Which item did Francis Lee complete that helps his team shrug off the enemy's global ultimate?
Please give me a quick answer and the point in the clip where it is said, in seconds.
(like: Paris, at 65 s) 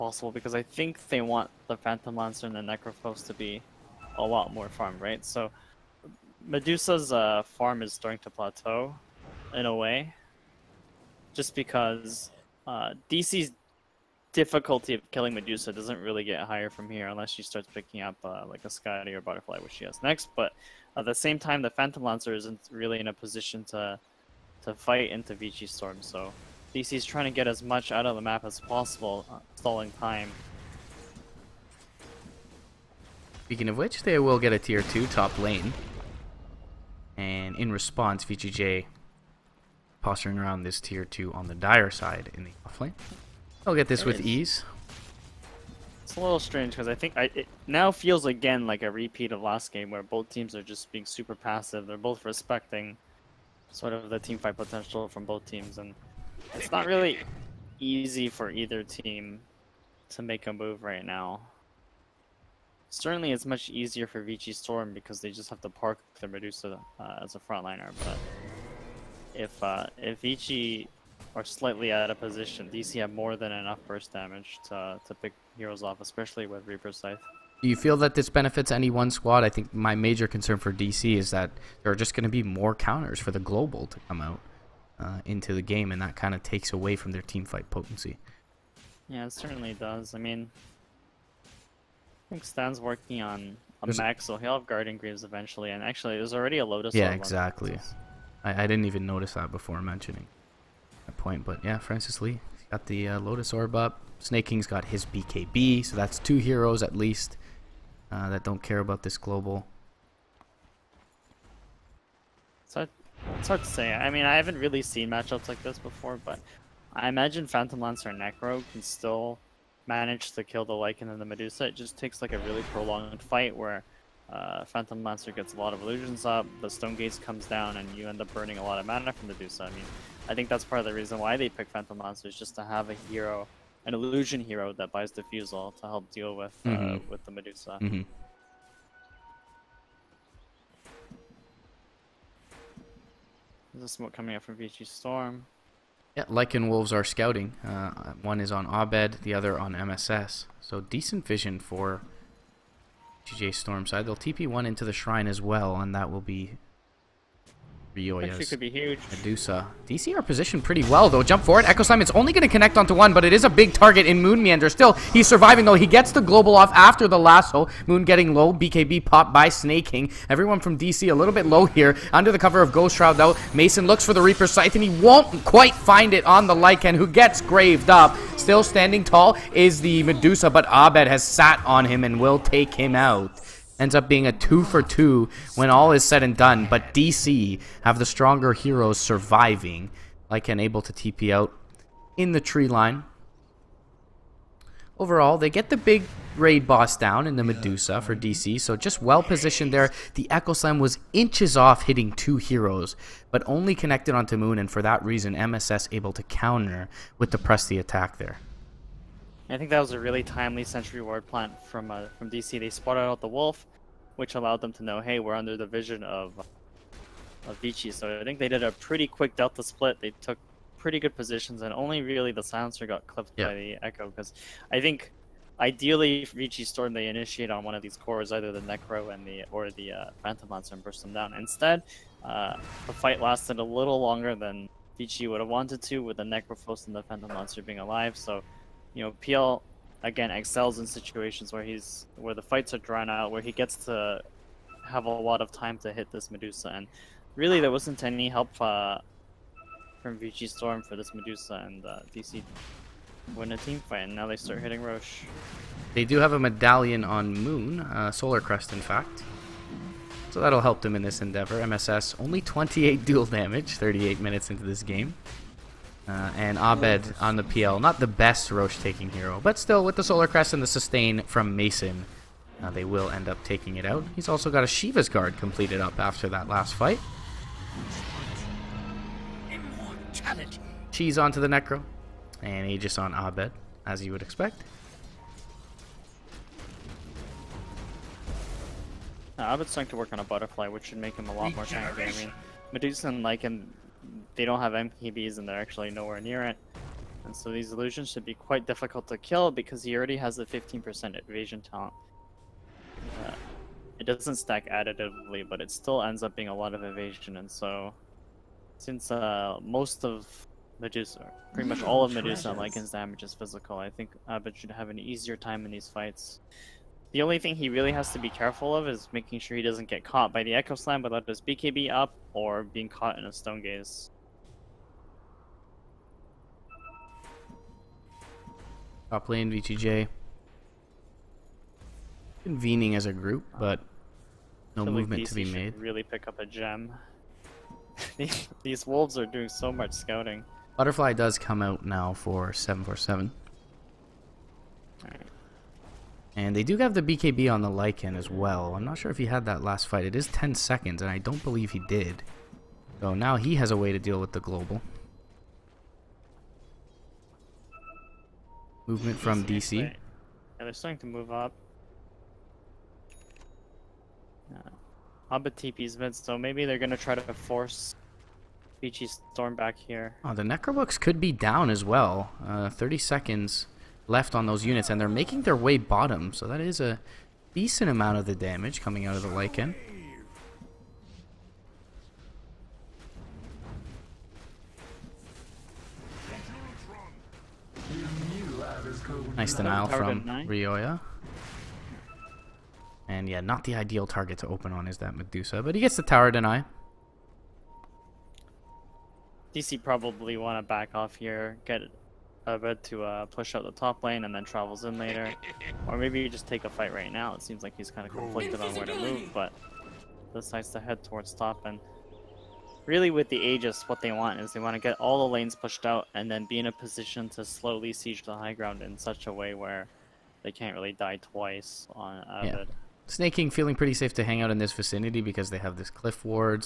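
Lotus Orb, at 103 s.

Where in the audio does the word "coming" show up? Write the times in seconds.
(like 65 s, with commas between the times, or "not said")
144 s, 378 s.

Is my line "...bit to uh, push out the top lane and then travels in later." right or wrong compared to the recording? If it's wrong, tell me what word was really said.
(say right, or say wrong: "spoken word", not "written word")
right.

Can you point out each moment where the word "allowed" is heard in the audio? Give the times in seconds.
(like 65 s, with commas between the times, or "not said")
214 s.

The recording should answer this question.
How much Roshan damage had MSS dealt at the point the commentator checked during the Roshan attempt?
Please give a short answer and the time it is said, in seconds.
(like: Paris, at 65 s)
28, at 262 s.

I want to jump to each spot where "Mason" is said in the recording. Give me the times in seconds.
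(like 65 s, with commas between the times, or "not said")
173 s, 271 s.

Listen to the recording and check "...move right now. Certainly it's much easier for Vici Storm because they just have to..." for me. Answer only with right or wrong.
right.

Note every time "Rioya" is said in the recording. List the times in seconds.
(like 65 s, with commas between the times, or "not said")
157 s, 390 s.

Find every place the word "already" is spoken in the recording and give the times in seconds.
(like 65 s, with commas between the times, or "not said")
96 s, 299 s.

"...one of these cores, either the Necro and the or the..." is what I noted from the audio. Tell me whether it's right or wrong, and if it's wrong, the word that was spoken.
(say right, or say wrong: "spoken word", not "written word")
right.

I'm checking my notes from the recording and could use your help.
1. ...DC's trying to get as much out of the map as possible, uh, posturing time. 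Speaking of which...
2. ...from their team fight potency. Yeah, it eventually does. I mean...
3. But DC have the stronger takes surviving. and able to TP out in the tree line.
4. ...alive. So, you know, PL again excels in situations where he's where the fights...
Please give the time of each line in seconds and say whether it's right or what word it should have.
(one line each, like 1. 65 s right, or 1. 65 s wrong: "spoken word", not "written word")
1. 26 s wrong: "stalling", not "posturing"
2. 86 s wrong: "certainly", not "eventually"
3. 186 s wrong: "heroes", not "takes"
4. 237 s right.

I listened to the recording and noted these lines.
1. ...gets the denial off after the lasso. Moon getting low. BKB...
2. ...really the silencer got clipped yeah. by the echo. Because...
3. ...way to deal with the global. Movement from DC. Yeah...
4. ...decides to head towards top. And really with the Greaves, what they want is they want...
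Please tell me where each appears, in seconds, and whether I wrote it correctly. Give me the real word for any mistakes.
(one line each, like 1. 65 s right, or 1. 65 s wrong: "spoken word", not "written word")
1. 165 s wrong: "global", not "denial"
2. 222 s right
3. 353 s right
4. 410 s wrong: "Aegis", not "Greaves".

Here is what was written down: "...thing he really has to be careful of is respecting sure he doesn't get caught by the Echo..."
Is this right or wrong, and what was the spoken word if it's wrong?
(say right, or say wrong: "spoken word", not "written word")
wrong: "making", not "respecting".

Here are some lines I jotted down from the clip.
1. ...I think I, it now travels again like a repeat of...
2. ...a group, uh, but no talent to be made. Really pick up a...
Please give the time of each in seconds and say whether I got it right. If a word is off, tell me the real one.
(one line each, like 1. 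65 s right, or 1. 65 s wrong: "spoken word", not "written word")
1. 46 s wrong: "feels", not "travels"
2. 333 s wrong: "movement", not "talent".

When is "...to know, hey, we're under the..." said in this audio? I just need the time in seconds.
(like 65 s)
214 s.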